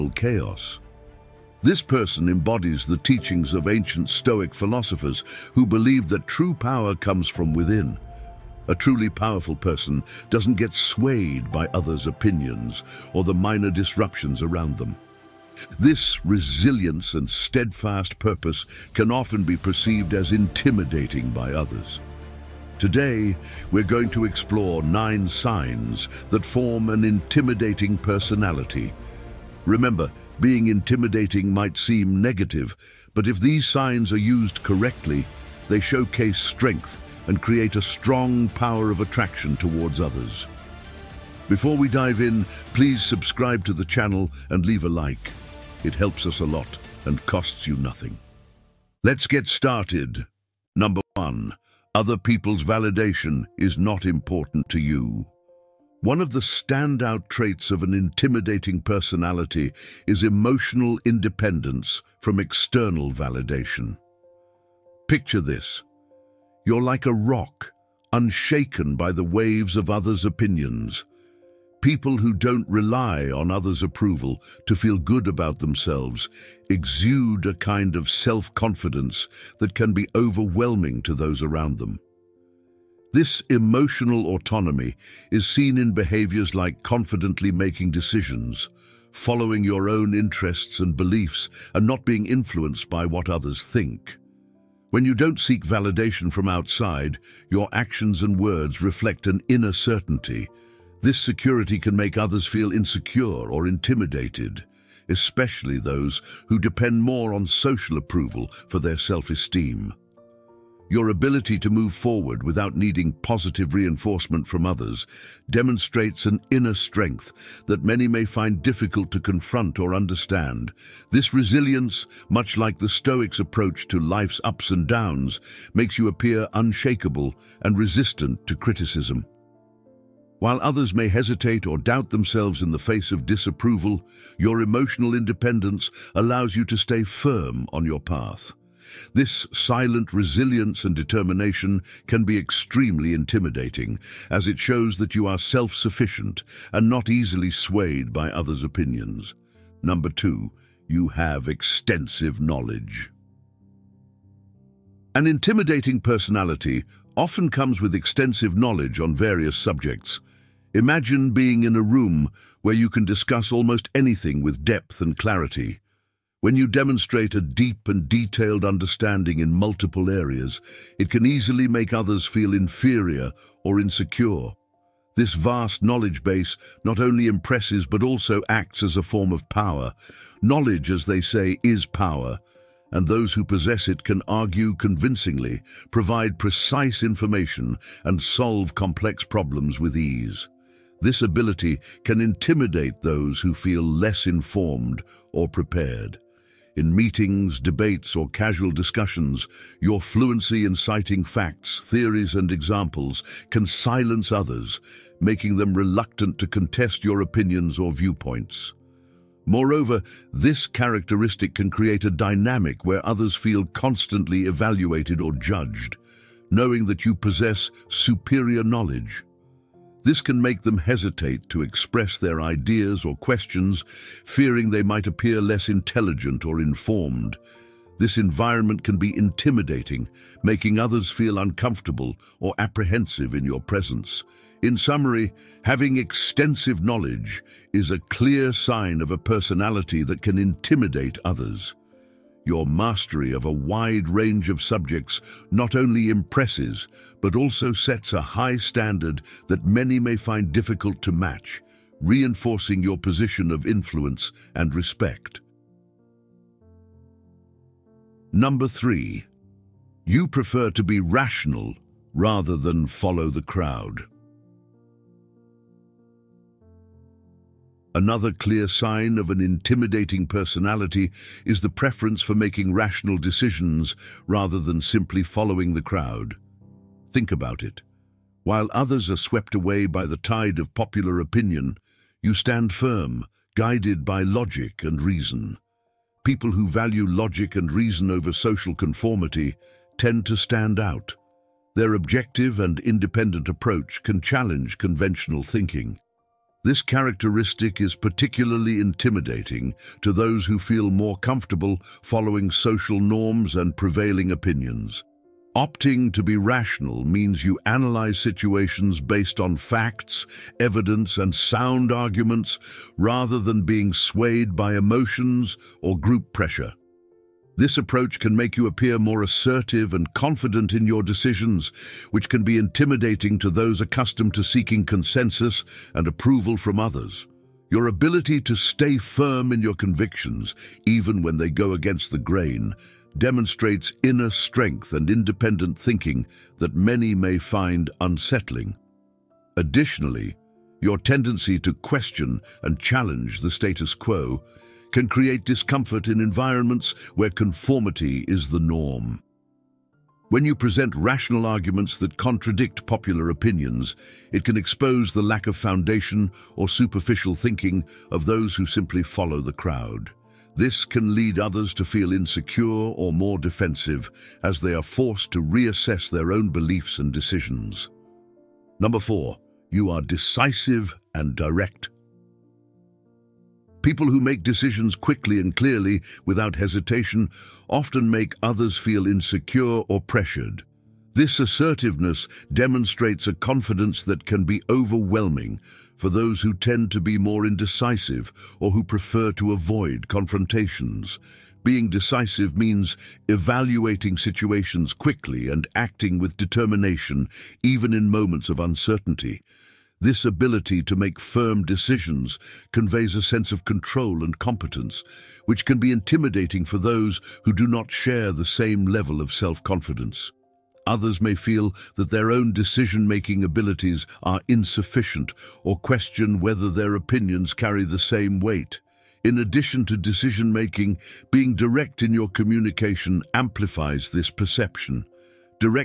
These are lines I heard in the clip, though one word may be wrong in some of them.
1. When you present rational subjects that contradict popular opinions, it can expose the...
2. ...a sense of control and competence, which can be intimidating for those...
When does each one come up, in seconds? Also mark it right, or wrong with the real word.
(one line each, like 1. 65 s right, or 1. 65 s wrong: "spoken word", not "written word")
1. 350 s wrong: "arguments", not "subjects"
2. 403 s right.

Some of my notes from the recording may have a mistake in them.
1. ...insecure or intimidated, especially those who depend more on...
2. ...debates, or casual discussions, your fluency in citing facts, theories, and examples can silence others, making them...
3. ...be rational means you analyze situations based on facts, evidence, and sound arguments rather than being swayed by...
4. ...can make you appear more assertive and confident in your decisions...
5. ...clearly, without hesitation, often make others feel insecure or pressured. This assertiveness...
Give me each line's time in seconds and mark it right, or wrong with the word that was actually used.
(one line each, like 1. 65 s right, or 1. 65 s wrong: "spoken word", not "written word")
1. 102 s right
2. 197 s right
3. 306 s right
4. 318 s right
5. 375 s right.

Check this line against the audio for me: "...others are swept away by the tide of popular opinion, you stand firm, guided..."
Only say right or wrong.
right.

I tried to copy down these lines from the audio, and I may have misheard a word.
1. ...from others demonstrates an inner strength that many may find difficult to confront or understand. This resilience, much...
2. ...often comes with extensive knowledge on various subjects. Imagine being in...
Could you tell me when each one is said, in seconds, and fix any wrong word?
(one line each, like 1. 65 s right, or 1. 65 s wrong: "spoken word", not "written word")
1. 114 s right
2. 157 s right.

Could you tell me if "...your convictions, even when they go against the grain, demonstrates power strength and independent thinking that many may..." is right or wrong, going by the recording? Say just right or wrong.
wrong.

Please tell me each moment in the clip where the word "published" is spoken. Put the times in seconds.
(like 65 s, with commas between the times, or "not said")
not said.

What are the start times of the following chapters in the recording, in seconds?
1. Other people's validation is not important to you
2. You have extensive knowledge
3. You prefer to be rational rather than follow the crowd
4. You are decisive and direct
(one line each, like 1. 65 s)
1. 50 s
2. 149 s
3. 258 s
4. 368 s.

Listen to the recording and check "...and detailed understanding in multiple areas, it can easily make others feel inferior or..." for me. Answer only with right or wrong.
right.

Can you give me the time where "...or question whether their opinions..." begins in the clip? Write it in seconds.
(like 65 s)
415 s.